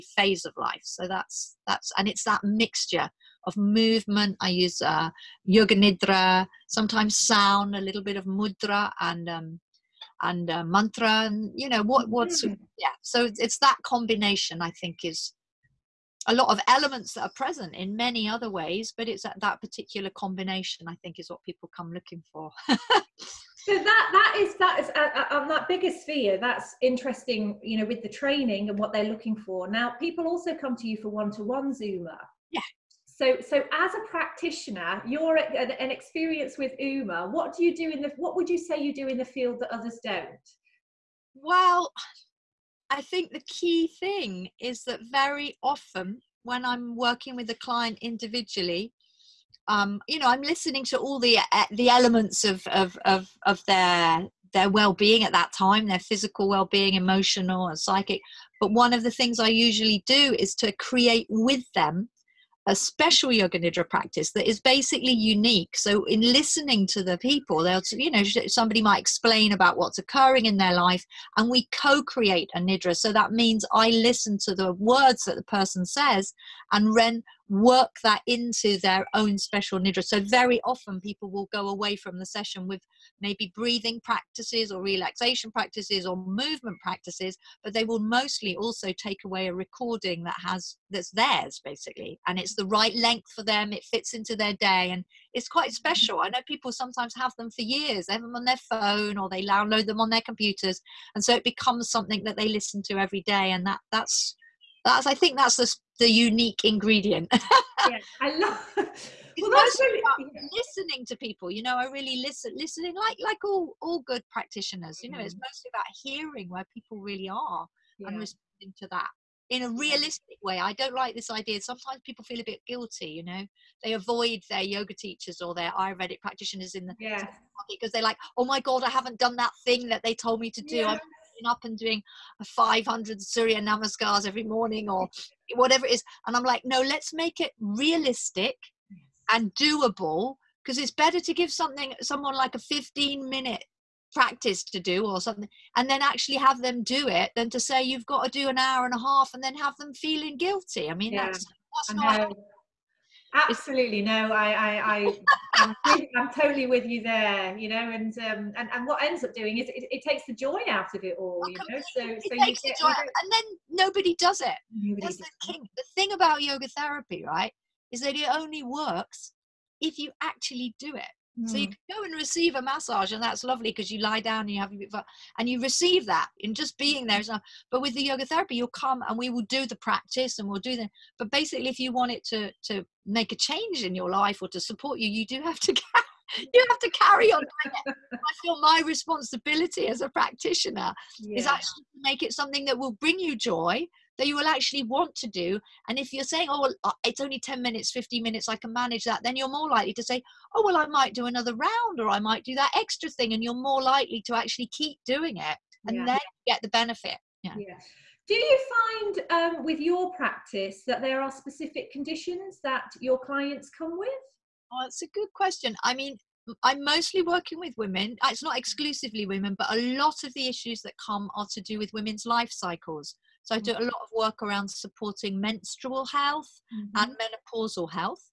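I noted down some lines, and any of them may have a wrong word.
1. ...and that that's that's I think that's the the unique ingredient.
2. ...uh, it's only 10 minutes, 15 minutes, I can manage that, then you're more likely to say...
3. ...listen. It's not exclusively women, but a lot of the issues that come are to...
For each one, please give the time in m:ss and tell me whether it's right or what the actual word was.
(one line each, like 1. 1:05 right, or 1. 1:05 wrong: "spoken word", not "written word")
1. 1:43 right
2. 3:16 right
3. 3:37 wrong: "women", not "listen".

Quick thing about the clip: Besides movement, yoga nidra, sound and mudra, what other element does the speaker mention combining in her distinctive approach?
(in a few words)
mantra.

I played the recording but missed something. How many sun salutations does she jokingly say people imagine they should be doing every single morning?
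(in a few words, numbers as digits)
500.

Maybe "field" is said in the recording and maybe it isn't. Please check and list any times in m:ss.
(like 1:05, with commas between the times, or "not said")
0:39.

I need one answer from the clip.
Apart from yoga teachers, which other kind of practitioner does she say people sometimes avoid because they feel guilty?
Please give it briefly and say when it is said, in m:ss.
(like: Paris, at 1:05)
Ayurvedic practitioners, at 2:05.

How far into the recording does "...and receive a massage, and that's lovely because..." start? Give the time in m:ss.
2:52.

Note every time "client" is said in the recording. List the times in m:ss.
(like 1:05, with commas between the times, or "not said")
0:47, 3:33.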